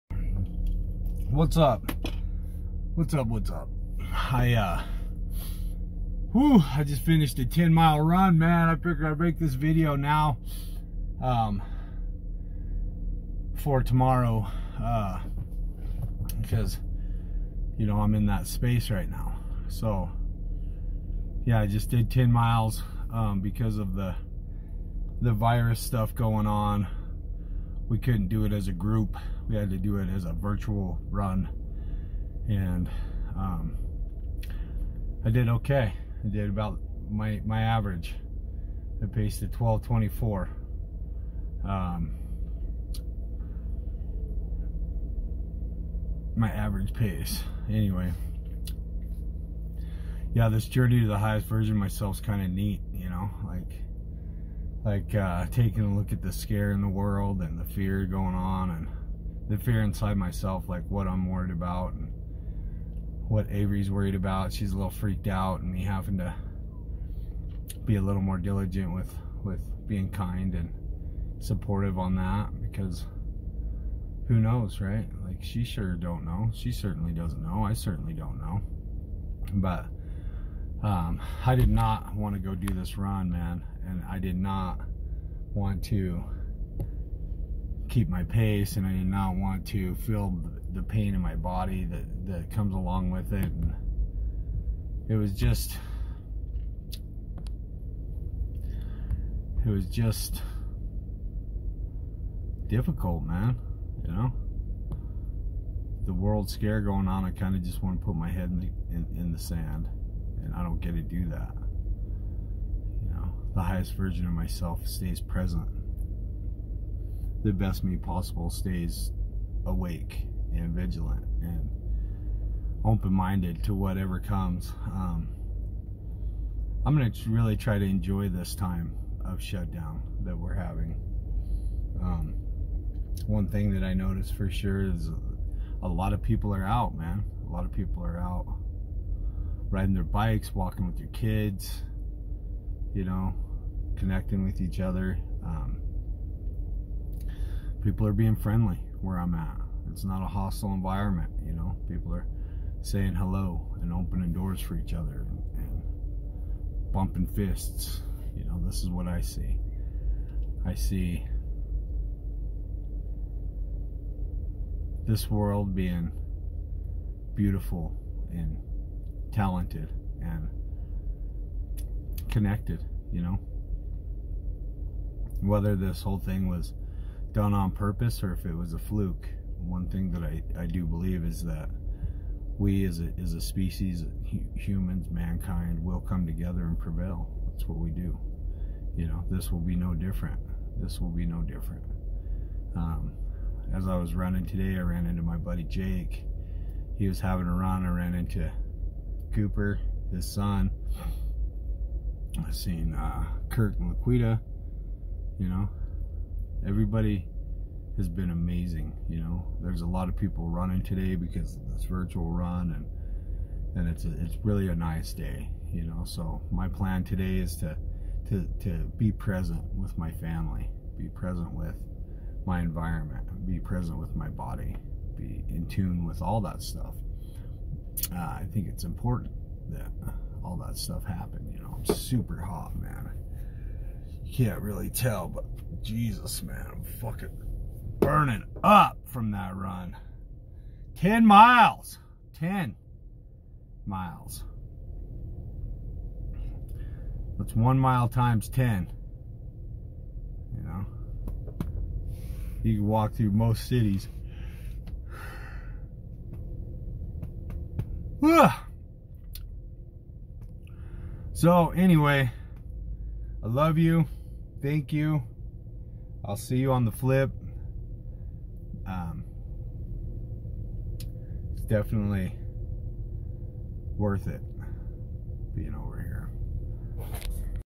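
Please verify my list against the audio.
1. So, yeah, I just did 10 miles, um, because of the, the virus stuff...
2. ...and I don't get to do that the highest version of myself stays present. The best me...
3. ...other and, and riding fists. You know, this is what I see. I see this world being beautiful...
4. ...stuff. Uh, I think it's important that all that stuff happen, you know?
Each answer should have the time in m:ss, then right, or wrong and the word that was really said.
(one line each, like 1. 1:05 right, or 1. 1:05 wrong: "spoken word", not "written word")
1. 0:19 right
2. 1:50 right
3. 2:34 wrong: "bumping", not "riding"
4. 3:46 right.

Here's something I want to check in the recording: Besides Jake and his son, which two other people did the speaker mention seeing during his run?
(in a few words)
Kirk and Laquita.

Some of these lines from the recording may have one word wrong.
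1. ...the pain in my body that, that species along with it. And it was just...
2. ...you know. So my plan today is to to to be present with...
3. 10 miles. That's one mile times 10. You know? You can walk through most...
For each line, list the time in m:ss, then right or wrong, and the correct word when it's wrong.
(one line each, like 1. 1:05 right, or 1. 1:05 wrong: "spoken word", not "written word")
1. 1:30 wrong: "comes", not "species"
2. 3:35 right
3. 4:02 right.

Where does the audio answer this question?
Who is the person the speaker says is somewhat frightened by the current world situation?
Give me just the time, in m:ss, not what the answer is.
1:03.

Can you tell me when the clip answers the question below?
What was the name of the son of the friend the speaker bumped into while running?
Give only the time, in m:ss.
3:19.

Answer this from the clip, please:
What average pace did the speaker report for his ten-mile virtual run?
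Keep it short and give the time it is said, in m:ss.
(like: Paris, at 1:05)
12:24, at 0:39.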